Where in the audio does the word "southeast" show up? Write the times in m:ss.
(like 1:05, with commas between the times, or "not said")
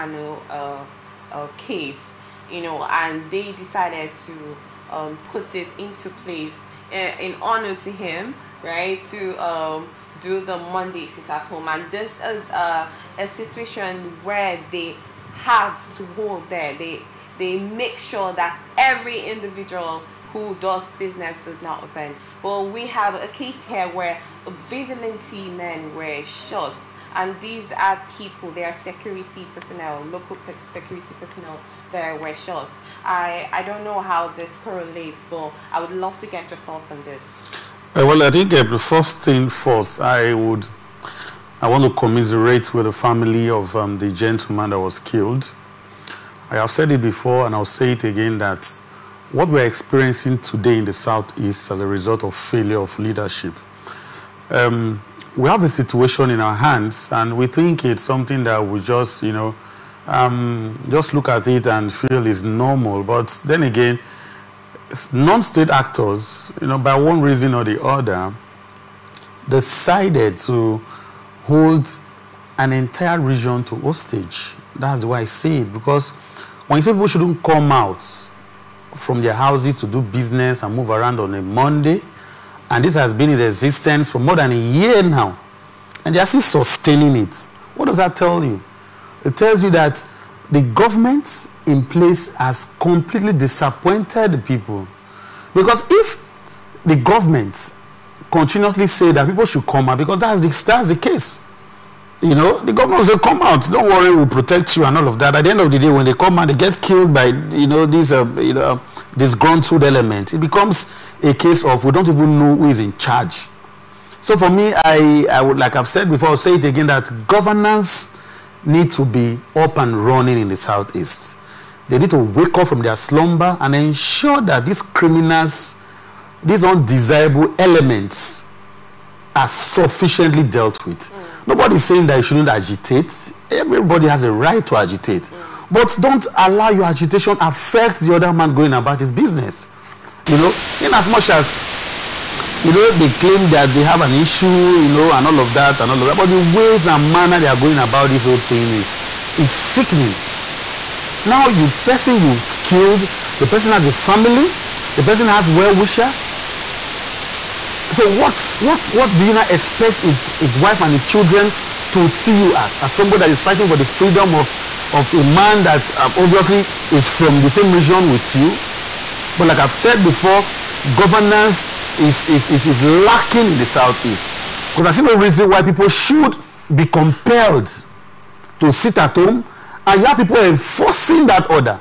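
0:50, 2:00, 2:53.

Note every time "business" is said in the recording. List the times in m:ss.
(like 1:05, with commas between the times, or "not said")
0:20, 1:20, 2:19.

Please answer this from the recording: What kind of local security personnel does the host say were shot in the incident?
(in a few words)
Vigilante men.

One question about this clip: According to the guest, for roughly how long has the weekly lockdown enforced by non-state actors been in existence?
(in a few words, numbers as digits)
More than a year.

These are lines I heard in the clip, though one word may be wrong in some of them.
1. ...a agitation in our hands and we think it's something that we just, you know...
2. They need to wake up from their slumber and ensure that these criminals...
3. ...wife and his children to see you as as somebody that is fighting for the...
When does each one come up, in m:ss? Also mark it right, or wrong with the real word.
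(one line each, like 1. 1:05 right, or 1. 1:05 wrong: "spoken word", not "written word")
1. 0:55 wrong: "situation", not "agitation"
2. 2:01 right
3. 2:40 right.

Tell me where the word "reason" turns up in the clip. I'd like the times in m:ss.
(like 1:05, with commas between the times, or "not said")
1:07, 2:55.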